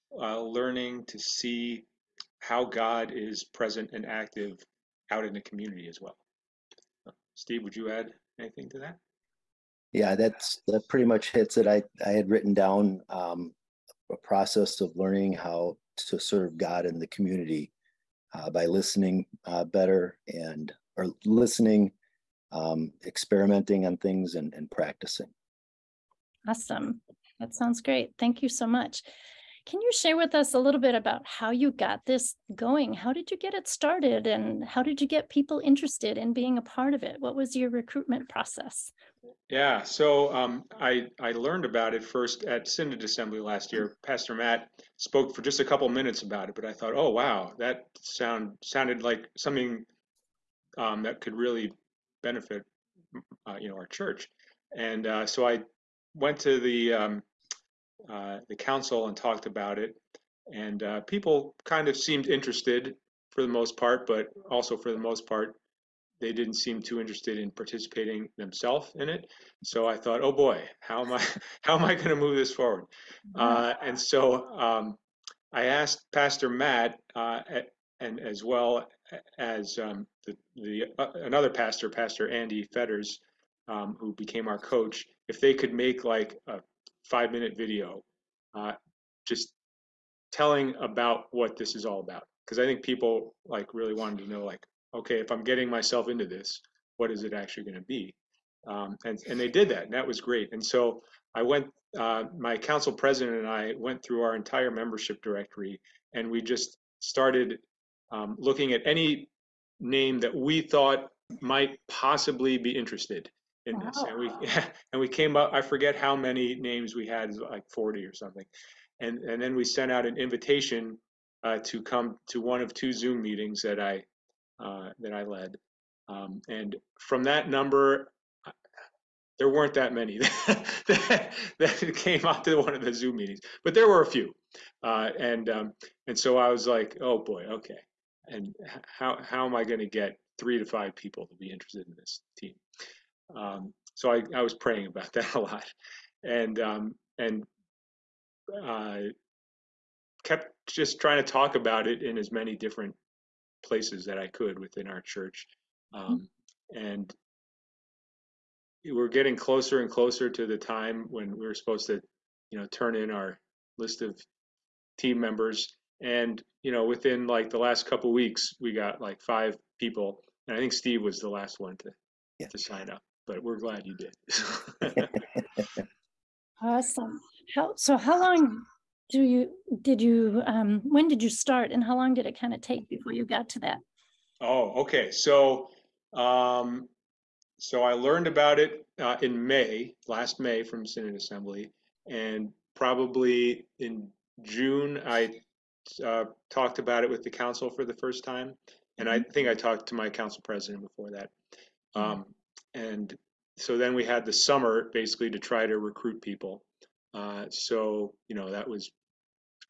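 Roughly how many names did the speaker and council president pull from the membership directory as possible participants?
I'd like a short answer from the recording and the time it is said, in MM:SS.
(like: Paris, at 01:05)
40, at 01:57.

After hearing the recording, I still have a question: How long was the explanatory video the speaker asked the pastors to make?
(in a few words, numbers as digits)
5 minutes.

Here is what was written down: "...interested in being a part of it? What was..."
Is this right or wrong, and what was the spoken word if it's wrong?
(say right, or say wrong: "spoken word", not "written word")
right.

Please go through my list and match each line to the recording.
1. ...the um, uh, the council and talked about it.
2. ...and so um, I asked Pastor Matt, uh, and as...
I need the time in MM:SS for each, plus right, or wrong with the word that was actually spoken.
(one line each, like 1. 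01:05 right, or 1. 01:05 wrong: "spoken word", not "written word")
1. 00:56 right
2. 01:13 right.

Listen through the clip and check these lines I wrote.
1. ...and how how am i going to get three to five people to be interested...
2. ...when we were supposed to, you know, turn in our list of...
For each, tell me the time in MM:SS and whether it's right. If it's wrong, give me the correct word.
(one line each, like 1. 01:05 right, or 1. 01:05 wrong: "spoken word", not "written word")
1. 02:18 right
2. 02:41 right.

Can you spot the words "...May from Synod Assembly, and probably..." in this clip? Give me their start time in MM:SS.
03:10.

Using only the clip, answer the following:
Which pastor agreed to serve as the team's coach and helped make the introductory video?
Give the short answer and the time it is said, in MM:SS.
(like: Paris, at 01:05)
Pastor Andy Fetters, at 01:21.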